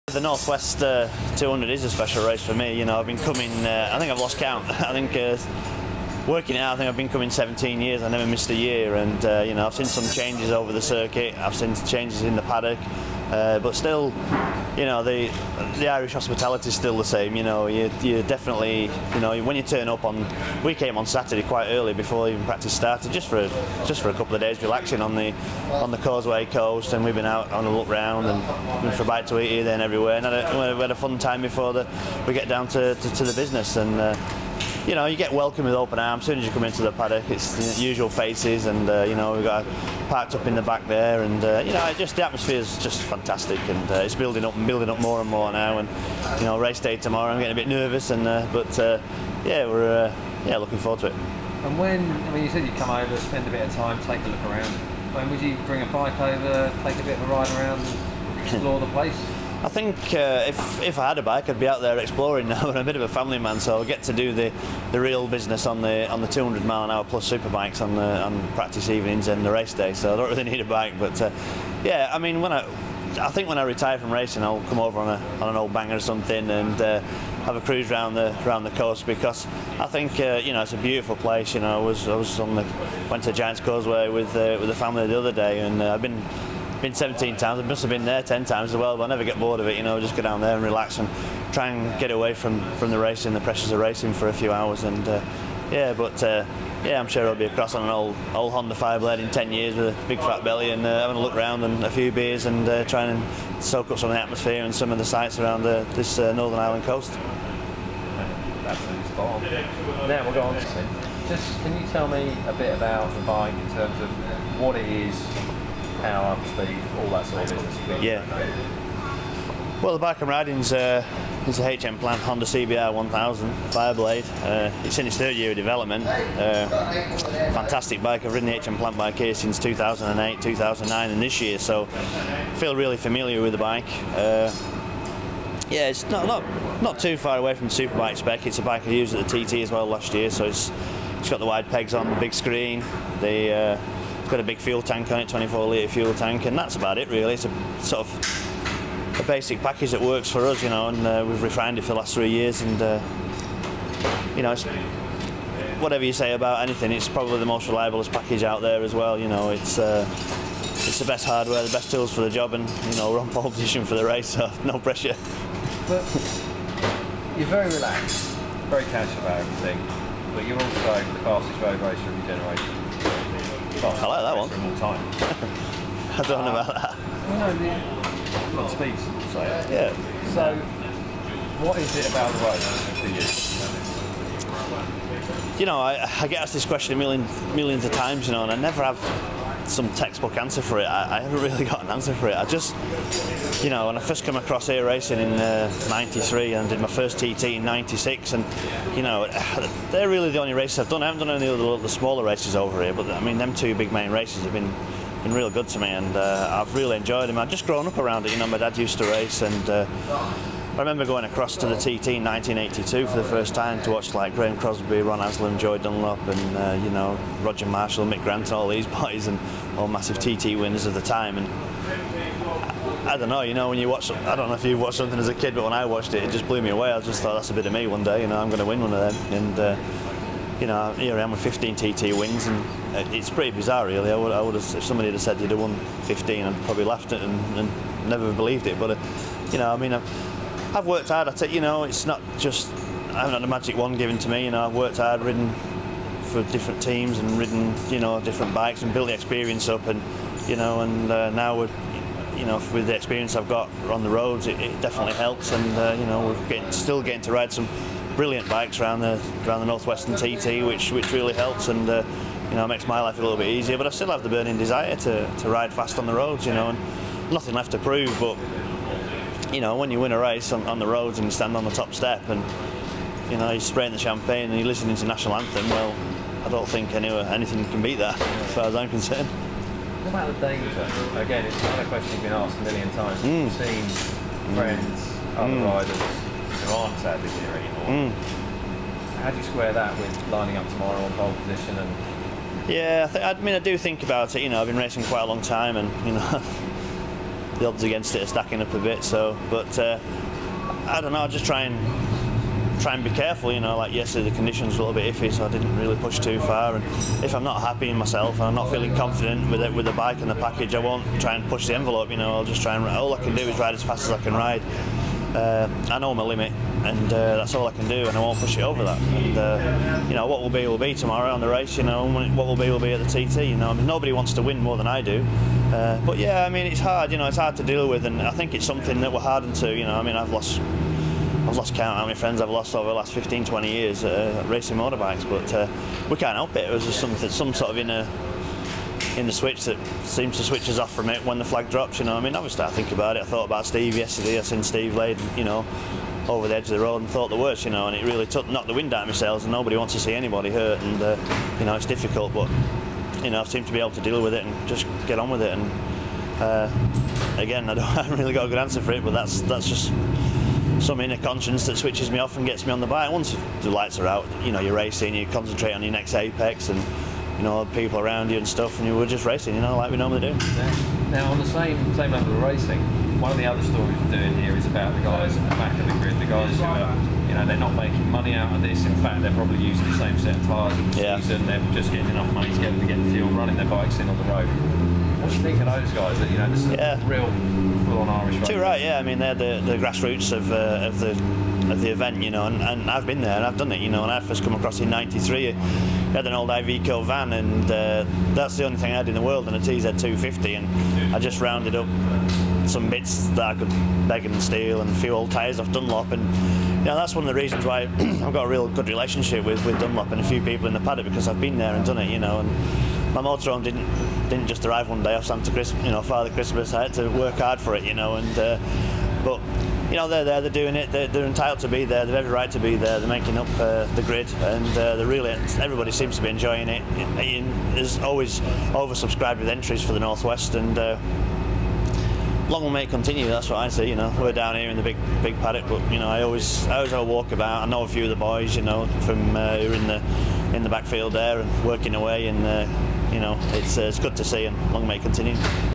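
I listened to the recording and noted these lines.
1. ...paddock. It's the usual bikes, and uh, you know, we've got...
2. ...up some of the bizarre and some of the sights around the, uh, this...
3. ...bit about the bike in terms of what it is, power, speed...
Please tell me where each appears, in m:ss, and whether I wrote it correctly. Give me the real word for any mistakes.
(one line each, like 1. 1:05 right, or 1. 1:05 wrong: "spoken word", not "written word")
1. 0:36 wrong: "faces", not "bikes"
2. 1:43 wrong: "atmosphere", not "bizarre"
3. 1:52 right.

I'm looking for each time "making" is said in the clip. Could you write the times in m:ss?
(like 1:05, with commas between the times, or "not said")
6:17, 7:03.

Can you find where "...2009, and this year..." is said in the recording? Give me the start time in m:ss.
2:10.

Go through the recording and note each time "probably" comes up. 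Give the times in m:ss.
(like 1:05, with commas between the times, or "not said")
2:37, 3:56, 6:19.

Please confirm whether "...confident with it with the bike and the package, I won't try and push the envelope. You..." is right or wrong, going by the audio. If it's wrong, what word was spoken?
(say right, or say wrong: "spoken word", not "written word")
right.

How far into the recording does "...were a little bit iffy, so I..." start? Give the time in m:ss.
5:04.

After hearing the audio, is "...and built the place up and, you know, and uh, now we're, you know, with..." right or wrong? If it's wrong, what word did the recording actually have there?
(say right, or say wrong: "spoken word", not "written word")
wrong: "experience", not "place".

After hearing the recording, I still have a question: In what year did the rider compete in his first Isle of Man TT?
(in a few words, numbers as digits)
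1996.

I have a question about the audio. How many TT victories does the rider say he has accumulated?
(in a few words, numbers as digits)
15.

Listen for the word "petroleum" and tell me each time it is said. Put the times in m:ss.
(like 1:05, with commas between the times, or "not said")
not said.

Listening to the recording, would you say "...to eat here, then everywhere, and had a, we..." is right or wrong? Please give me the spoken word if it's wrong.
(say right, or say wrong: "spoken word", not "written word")
right.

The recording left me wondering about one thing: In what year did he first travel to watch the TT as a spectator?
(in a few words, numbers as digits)
1982.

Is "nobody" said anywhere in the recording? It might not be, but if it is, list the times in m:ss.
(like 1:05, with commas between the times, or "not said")
5:23, 5:49.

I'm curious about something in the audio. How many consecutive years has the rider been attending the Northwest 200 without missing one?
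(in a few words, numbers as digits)
17.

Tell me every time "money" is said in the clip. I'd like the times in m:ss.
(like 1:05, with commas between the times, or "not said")
6:18, 6:22.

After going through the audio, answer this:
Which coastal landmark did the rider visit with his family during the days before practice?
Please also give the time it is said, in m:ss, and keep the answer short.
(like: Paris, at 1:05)
Giants Causeway, at 1:23.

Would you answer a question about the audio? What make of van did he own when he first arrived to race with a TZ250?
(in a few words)
Iveco.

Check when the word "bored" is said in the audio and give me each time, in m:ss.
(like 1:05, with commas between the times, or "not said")
1:29.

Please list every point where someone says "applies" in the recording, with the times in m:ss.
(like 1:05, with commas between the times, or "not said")
not said.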